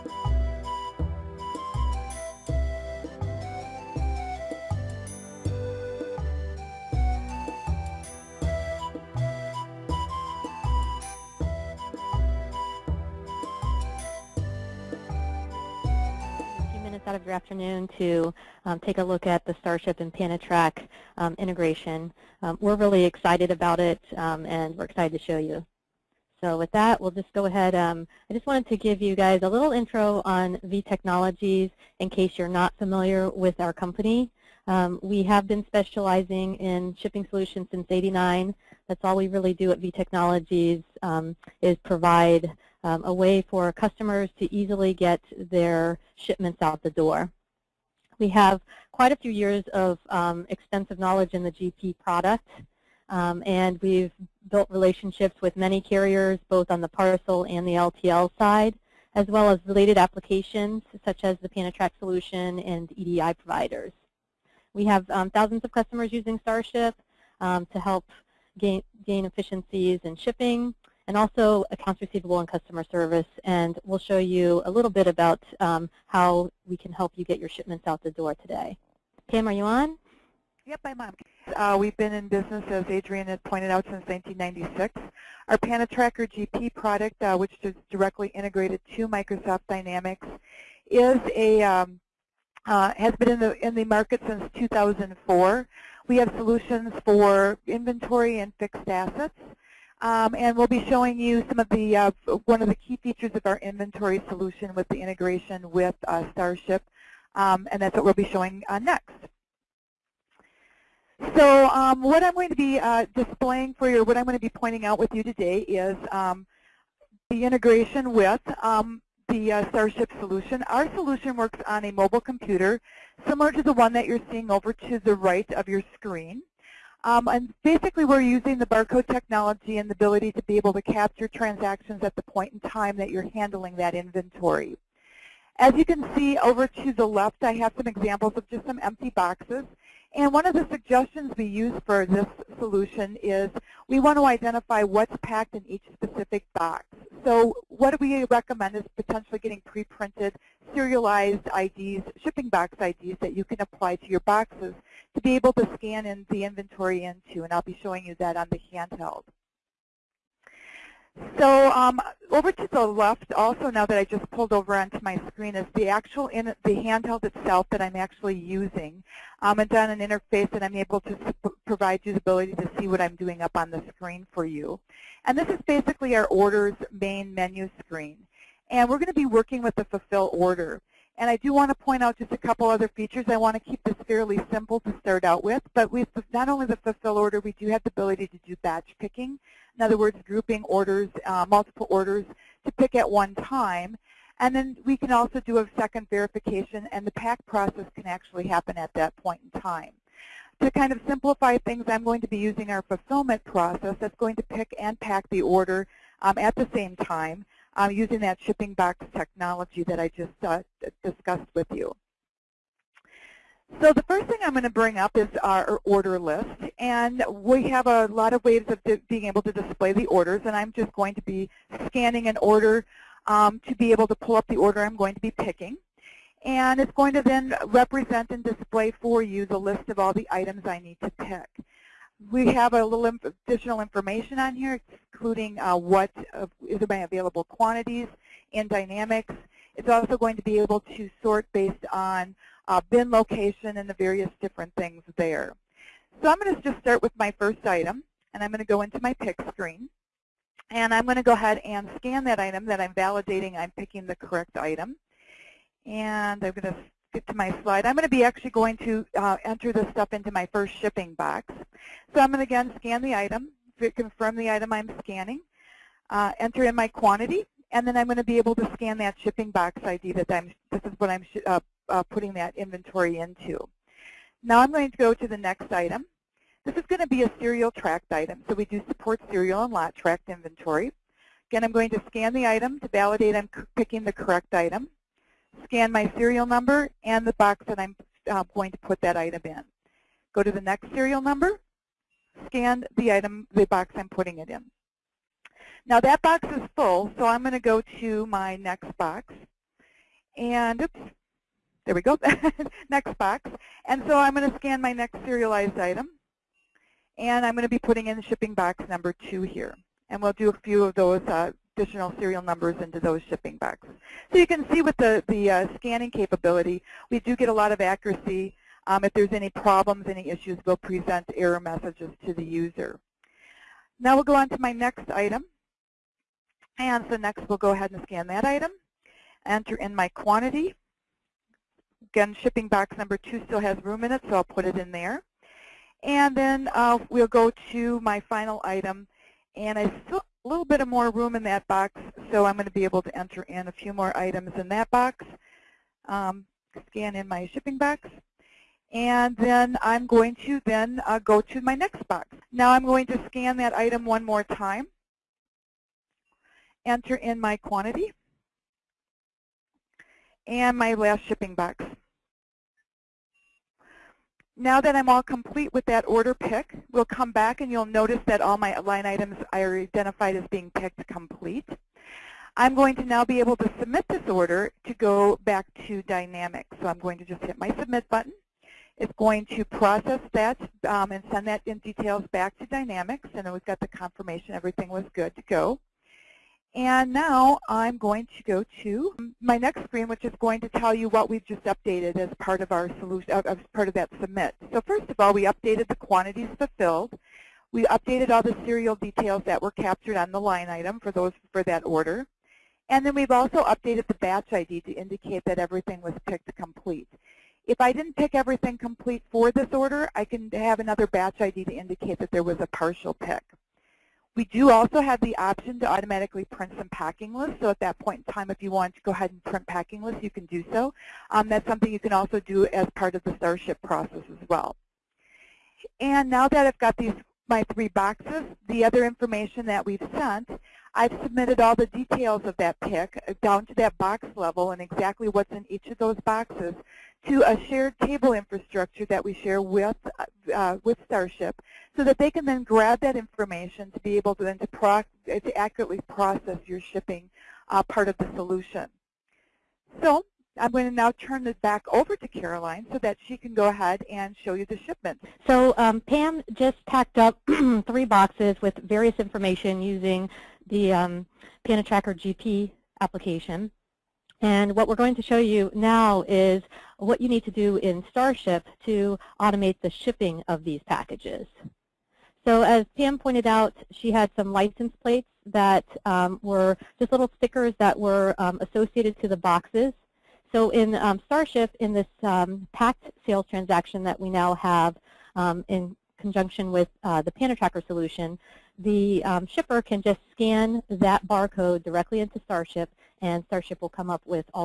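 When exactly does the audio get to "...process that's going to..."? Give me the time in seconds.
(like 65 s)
203 s.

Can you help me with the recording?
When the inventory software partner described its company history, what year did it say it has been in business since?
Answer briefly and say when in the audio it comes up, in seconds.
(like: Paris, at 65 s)
1996, at 83 s.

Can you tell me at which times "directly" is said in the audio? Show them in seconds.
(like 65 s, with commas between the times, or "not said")
87 s, 491 s.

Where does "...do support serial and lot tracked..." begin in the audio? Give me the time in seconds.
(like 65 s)
278 s.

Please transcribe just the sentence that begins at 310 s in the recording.
And we'll do a few of those uh, additional serial numbers into those shipping bucks.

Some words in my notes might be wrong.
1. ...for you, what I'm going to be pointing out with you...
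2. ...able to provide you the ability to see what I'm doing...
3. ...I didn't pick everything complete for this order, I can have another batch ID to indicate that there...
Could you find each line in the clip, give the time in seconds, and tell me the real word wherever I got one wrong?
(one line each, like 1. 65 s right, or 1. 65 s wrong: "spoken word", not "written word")
1. 113 s right
2. 170 s right
3. 407 s right.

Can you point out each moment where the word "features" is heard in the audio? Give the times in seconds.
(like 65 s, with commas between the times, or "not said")
103 s, 182 s.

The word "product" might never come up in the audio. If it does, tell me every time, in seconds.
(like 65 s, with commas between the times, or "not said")
52 s, 86 s.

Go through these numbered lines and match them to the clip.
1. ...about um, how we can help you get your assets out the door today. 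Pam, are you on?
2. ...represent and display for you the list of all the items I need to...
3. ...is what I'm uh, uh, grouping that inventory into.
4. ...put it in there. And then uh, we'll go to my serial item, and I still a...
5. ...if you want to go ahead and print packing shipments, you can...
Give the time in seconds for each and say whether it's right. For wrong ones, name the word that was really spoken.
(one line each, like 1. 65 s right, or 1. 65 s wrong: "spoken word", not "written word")
1. 75 s wrong: "shipments", not "assets"
2. 227 s right
3. 270 s wrong: "putting", not "grouping"
4. 334 s wrong: "final", not "serial"
5. 418 s wrong: "lists", not "shipments".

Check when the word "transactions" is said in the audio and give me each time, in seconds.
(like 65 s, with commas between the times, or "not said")
131 s, 483 s.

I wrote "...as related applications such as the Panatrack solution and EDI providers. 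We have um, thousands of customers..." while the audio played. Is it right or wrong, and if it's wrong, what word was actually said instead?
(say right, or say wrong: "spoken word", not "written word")
right.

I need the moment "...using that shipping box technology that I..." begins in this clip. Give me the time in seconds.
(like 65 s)
207 s.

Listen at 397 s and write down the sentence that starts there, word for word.
We updated all the serial details that were captured on the line item for those for that order.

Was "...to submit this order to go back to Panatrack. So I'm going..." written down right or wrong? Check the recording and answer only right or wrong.
wrong.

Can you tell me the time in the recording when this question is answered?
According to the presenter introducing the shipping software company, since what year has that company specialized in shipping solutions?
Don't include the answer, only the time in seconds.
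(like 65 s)
37 s.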